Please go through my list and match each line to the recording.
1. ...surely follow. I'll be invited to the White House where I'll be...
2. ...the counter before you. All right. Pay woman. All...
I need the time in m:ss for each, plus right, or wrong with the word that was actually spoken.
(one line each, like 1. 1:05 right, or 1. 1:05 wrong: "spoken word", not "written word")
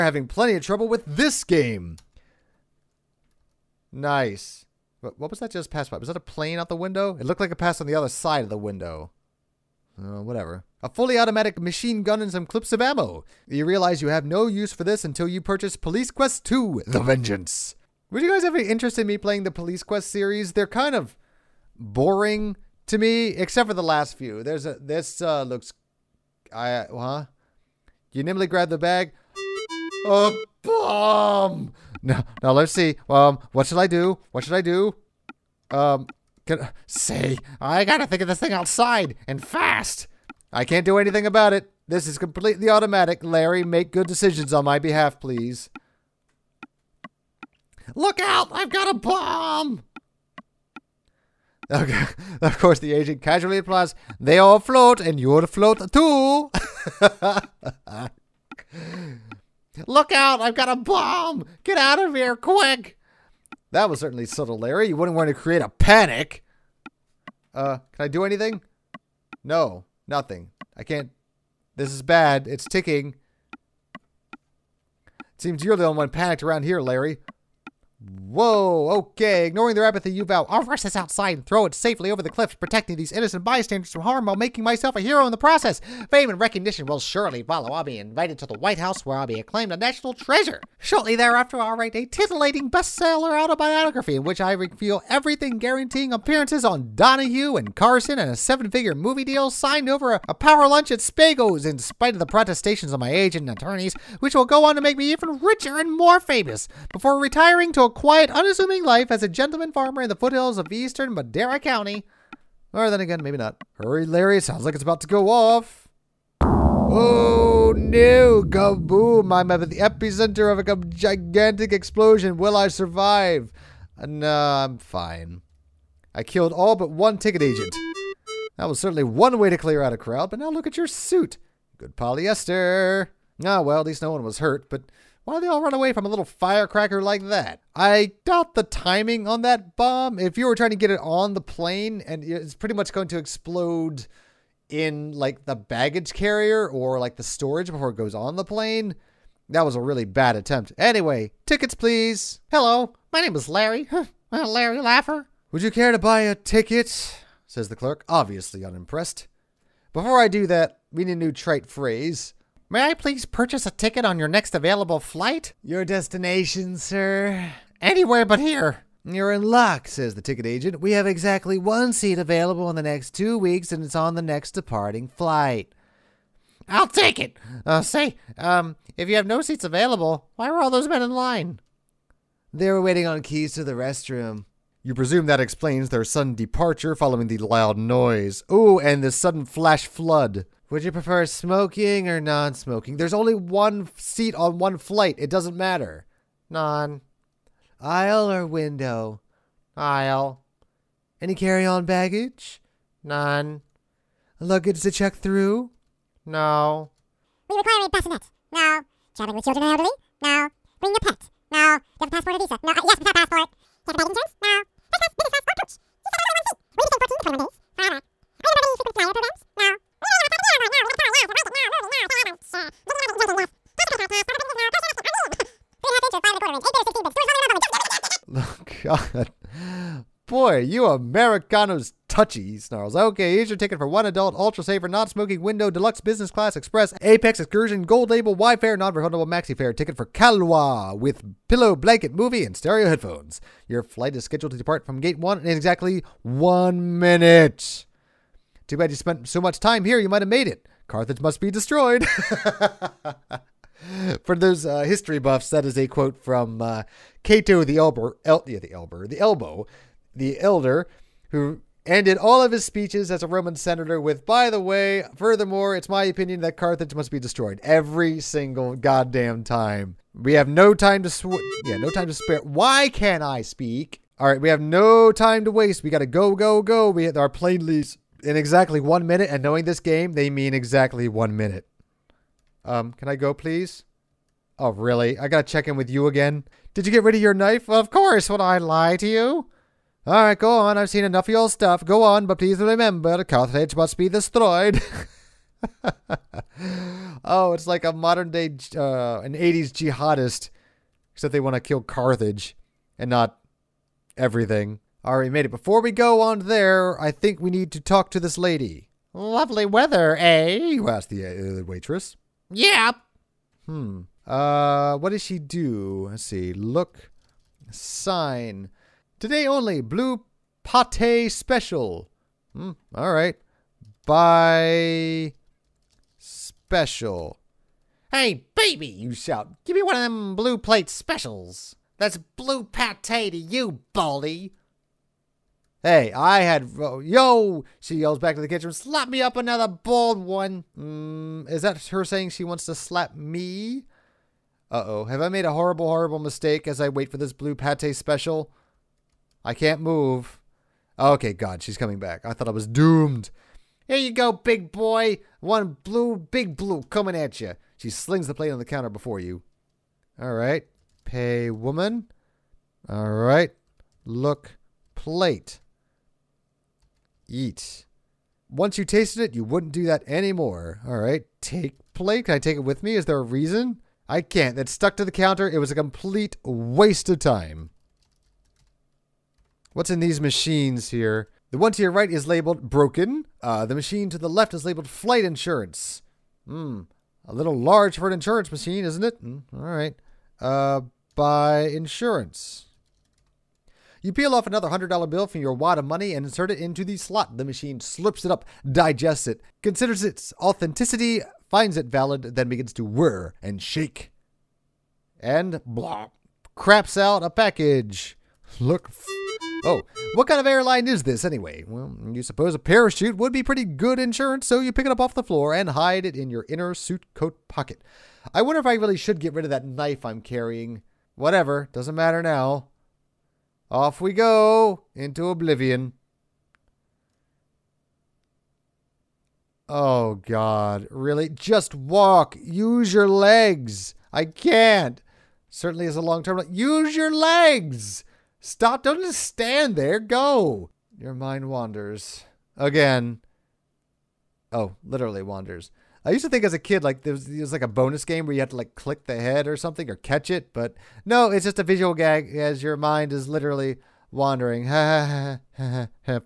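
1. 1:26 right
2. 5:58 right.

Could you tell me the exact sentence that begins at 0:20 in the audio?
They're kind of boring to me, except for the last few.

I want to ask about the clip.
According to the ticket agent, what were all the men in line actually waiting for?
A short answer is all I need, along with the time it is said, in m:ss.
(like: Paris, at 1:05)
Keys to the restroom, at 3:03.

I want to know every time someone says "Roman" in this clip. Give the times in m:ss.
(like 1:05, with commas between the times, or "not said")
4:23.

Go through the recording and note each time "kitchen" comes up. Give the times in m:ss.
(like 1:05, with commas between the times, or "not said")
5:38.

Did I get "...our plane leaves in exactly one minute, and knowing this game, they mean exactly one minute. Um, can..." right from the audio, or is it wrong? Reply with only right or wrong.
right.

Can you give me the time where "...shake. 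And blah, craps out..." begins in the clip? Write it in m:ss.
6:43.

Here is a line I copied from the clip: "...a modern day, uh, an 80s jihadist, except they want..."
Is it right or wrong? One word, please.
right.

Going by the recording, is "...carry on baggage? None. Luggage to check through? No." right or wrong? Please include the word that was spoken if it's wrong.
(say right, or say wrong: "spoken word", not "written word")
right.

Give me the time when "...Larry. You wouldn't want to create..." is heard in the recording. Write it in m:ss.
1:04.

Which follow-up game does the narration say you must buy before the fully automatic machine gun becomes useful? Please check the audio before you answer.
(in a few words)
Police Quest 2.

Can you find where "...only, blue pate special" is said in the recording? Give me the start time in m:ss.
5:19.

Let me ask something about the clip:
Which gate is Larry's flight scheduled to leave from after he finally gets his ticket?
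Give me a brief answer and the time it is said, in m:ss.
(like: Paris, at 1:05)
Gate 1, at 4:05.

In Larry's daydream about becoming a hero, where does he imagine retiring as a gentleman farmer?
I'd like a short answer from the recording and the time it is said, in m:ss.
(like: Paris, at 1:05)
Madera County, at 1:50.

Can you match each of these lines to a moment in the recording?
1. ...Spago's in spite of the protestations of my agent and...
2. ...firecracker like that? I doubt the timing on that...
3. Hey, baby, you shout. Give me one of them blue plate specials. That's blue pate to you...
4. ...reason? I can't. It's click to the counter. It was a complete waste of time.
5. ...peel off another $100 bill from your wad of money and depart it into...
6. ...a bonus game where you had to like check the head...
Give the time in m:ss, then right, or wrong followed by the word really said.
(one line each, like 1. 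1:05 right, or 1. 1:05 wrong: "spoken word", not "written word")
1. 1:40 right
2. 2:16 right
3. 5:28 right
4. 6:13 wrong: "stuck", not "click"
5. 6:34 wrong: "insert", not "depart"
6. 7:27 wrong: "click", not "check".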